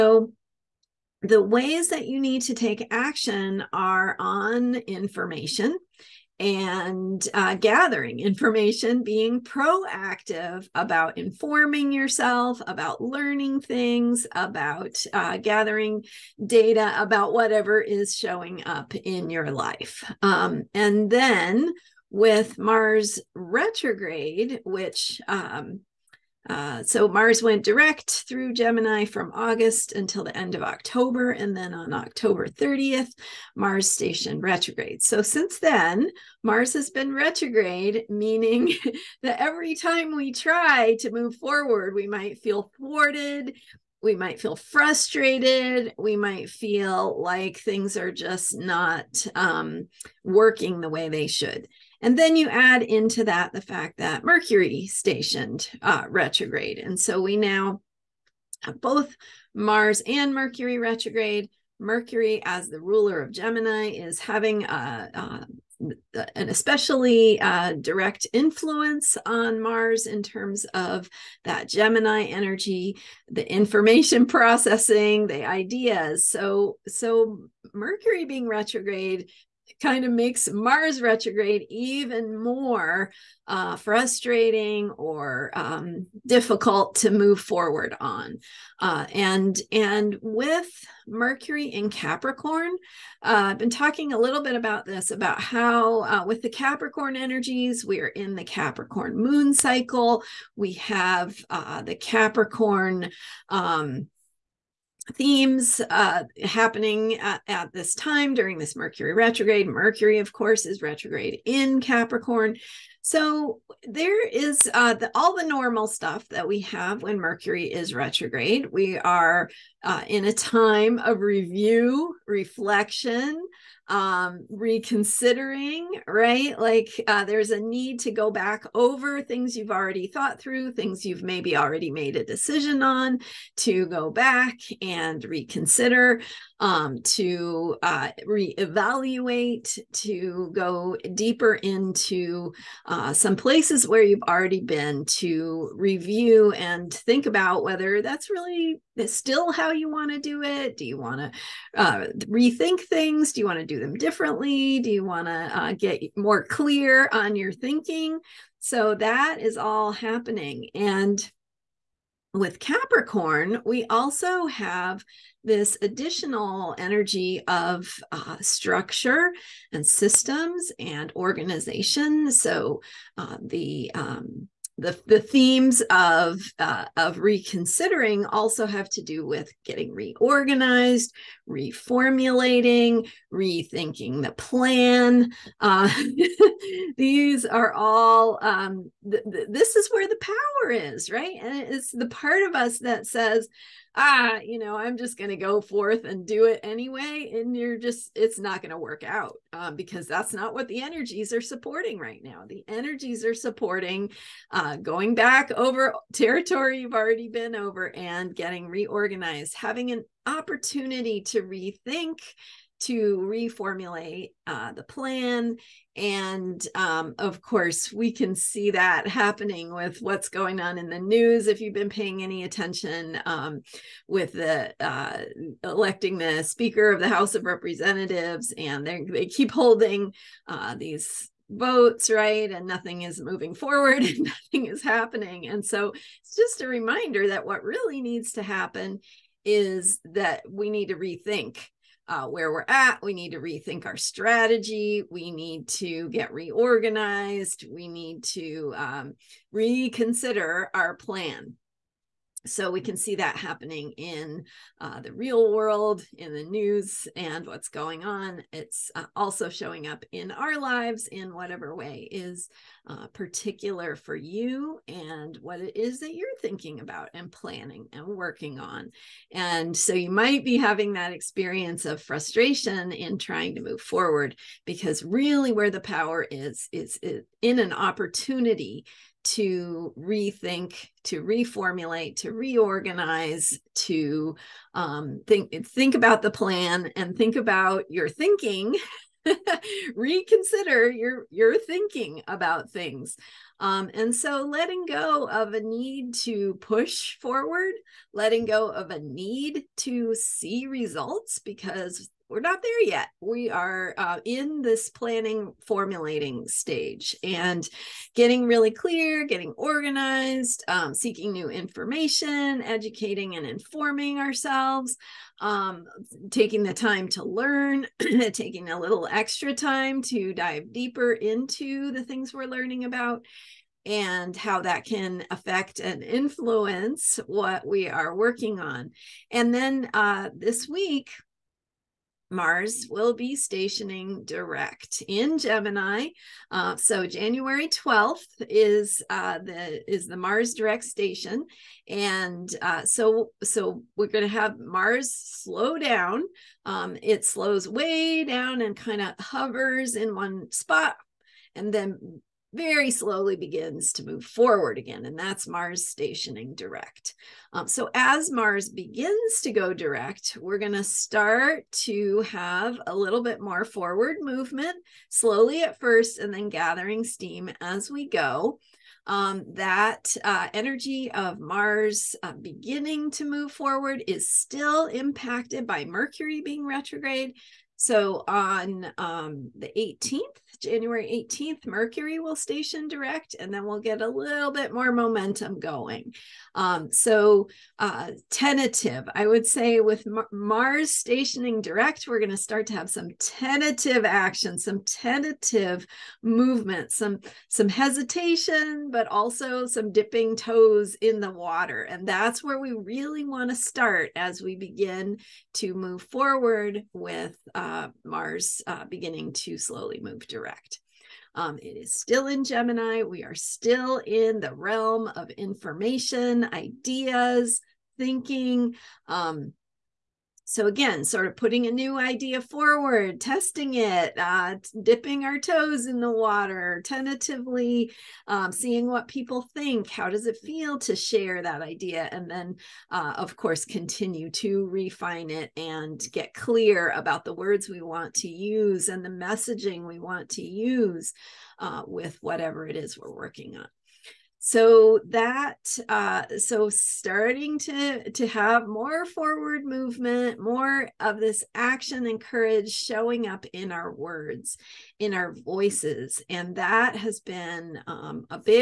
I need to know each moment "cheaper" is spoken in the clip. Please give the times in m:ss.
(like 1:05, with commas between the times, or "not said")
not said.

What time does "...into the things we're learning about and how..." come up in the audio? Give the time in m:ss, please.
5:21.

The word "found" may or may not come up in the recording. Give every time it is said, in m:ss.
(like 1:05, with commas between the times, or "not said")
not said.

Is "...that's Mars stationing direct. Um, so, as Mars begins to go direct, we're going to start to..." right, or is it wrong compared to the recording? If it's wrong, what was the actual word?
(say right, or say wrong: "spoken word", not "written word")
right.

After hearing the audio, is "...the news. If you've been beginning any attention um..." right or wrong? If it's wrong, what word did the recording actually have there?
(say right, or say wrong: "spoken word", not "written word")
wrong: "paying", not "beginning".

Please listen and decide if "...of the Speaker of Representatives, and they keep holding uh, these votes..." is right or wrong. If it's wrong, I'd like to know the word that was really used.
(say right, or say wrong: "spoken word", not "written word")
wrong: "House", not "Speaker".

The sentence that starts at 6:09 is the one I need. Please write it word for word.
Um, that uh, energy of Mars uh, beginning to move forward is still impacted by Mercury being retrograde.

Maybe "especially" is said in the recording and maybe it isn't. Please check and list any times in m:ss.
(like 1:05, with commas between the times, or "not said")
1:06.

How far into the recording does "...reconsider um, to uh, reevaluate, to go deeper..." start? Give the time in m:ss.
2:15.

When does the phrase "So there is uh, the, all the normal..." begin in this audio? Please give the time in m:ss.
1:53.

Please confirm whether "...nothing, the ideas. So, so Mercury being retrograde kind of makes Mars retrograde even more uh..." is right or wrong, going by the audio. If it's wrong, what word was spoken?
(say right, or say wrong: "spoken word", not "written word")
wrong: "processing", not "nothing".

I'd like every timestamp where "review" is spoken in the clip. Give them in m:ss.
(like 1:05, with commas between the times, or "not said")
2:01, 2:25.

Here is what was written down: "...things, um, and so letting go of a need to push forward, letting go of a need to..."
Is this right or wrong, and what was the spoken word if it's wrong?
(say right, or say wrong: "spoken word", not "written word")
right.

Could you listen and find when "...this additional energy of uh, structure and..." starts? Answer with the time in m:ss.
2:45.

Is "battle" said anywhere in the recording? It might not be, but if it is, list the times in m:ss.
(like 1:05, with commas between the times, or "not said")
not said.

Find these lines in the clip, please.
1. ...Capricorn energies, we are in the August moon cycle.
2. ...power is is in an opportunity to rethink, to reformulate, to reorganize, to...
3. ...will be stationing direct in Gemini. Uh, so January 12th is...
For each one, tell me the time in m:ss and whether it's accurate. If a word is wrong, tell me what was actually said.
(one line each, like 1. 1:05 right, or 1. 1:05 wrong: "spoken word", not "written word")
1. 1:36 wrong: "Capricorn", not "August"
2. 4:35 right
3. 5:32 right.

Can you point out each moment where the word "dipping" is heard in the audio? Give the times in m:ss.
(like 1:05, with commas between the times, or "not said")
6:39, 7:04.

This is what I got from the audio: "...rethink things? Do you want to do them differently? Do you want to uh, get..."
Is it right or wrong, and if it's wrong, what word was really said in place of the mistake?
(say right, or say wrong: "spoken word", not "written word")
right.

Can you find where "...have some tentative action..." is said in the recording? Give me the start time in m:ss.
6:32.